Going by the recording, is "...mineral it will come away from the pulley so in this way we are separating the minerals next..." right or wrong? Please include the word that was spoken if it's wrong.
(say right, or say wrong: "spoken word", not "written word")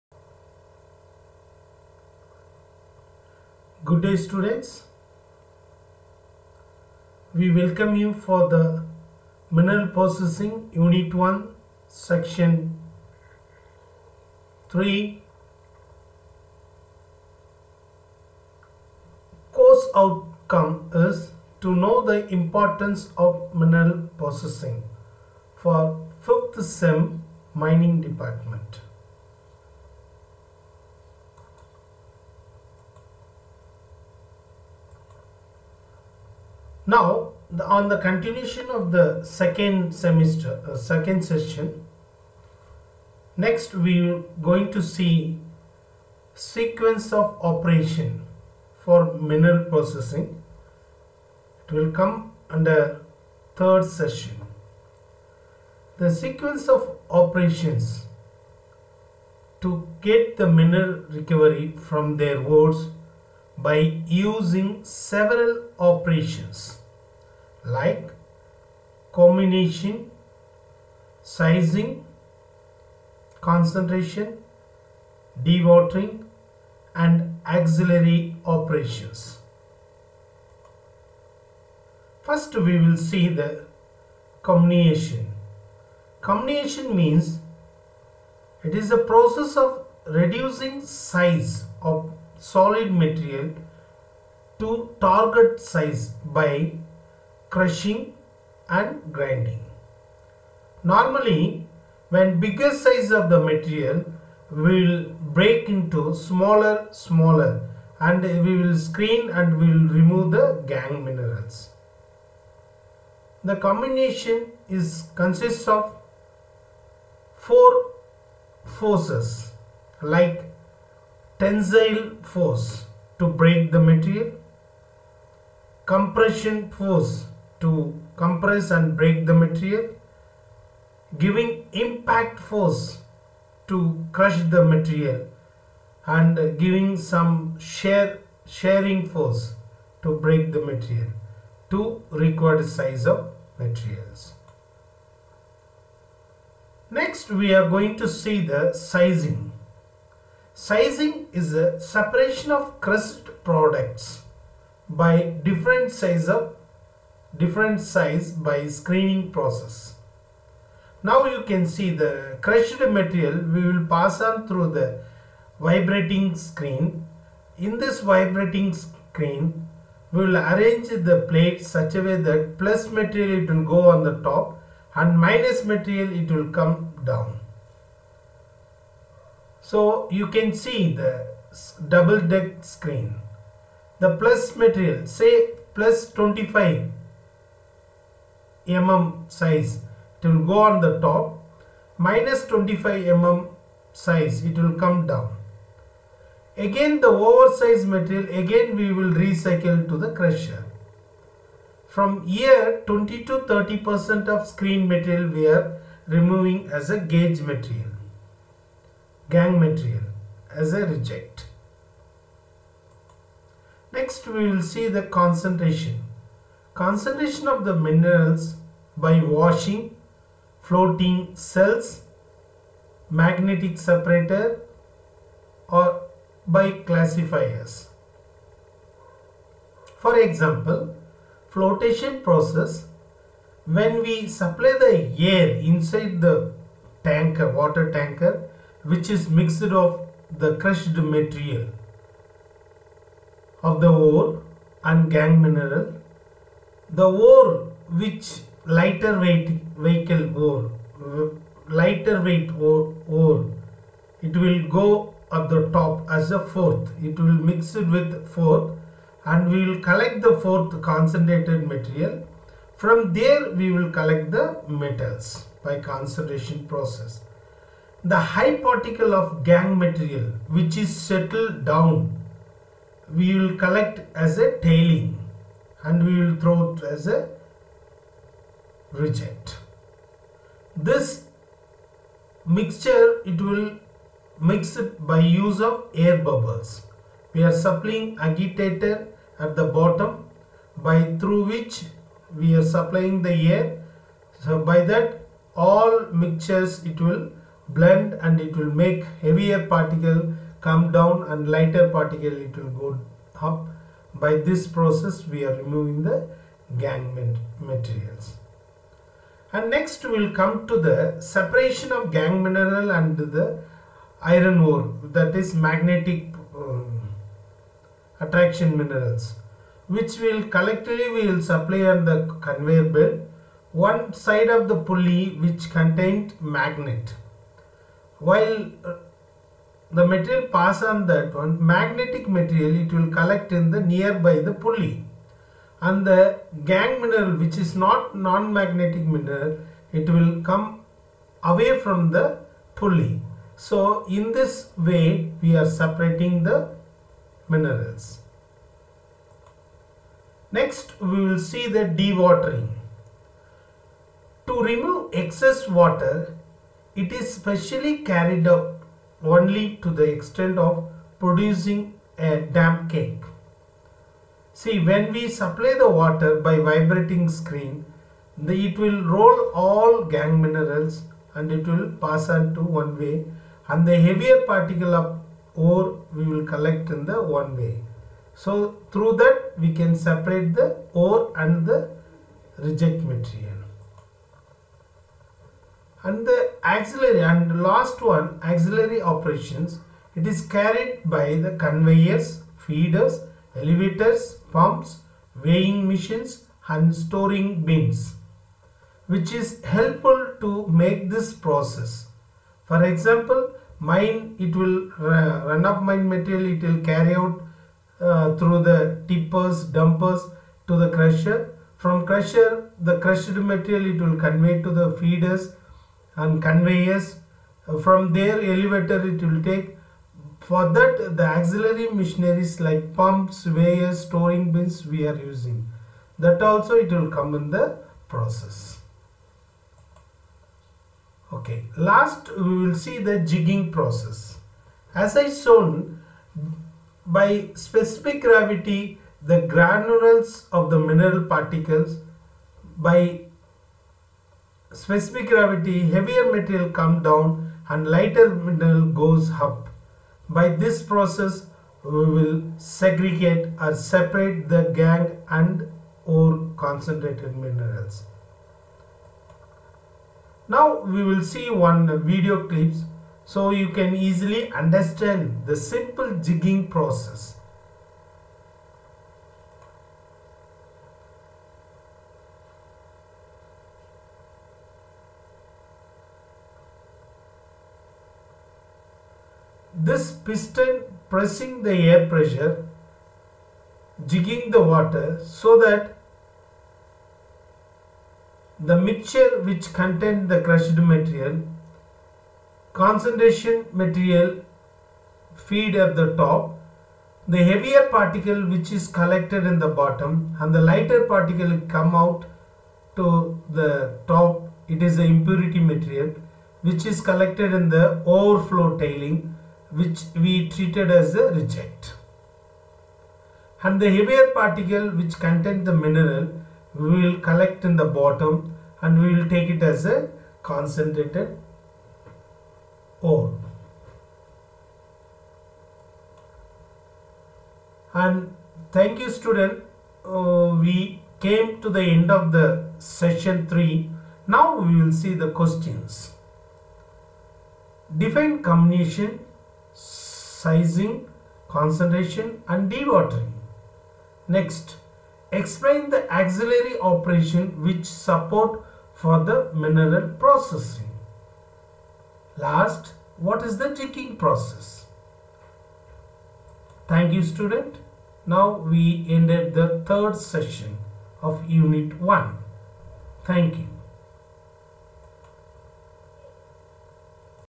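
right.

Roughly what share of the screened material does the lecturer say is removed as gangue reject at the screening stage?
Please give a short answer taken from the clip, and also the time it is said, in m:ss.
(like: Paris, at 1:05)
20 to 30 percent, at 3:22.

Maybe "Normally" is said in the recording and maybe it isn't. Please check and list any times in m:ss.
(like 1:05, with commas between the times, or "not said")
1:40.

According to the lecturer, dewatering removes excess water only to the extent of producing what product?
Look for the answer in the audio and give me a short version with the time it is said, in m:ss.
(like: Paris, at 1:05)
damp cake, at 6:02.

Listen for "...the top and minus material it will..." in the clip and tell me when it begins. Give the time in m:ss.
2:54.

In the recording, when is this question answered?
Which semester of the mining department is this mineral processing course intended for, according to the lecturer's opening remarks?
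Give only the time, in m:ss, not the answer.
0:26.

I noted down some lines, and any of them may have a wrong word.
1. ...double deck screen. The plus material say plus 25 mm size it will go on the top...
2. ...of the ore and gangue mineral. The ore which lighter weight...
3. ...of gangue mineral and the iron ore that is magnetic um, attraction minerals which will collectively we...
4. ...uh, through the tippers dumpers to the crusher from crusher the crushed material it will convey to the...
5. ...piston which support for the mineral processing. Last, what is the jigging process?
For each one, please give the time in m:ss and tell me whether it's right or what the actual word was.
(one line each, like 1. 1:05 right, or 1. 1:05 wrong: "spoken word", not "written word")
1. 3:01 right
2. 4:03 right
3. 5:11 right
4. 6:47 right
5. 9:06 wrong: "operation", not "piston".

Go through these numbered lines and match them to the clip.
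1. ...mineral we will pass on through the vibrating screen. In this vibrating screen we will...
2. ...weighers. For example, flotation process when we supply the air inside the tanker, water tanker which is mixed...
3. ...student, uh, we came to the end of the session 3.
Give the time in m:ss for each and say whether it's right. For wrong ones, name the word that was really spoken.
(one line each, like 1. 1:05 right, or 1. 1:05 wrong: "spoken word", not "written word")
1. 2:42 wrong: "material", not "mineral"
2. 3:46 wrong: "classifiers", not "weighers"
3. 8:49 right.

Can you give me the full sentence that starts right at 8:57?
Define comminution sizing, concentration and dewatering.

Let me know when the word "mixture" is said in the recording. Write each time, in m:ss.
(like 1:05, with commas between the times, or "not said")
4:42, 4:56, 8:08.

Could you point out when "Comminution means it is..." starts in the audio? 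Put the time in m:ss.
1:26.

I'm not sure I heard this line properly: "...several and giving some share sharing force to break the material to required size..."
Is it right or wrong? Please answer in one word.
wrong.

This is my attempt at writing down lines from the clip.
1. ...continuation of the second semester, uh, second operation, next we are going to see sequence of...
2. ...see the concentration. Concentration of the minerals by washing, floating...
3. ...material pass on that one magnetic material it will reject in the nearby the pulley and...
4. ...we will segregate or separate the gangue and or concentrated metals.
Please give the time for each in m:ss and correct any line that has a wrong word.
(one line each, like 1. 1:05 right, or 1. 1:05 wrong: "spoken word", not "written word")
1. 0:37 wrong: "session", not "operation"
2. 3:34 right
3. 5:30 wrong: "collect", not "reject"
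4. 7:31 wrong: "minerals", not "metals".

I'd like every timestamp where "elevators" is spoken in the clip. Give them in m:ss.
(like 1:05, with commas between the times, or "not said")
6:33, 6:58.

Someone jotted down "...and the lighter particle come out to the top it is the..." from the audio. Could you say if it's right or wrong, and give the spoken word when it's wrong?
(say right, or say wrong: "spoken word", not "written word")
right.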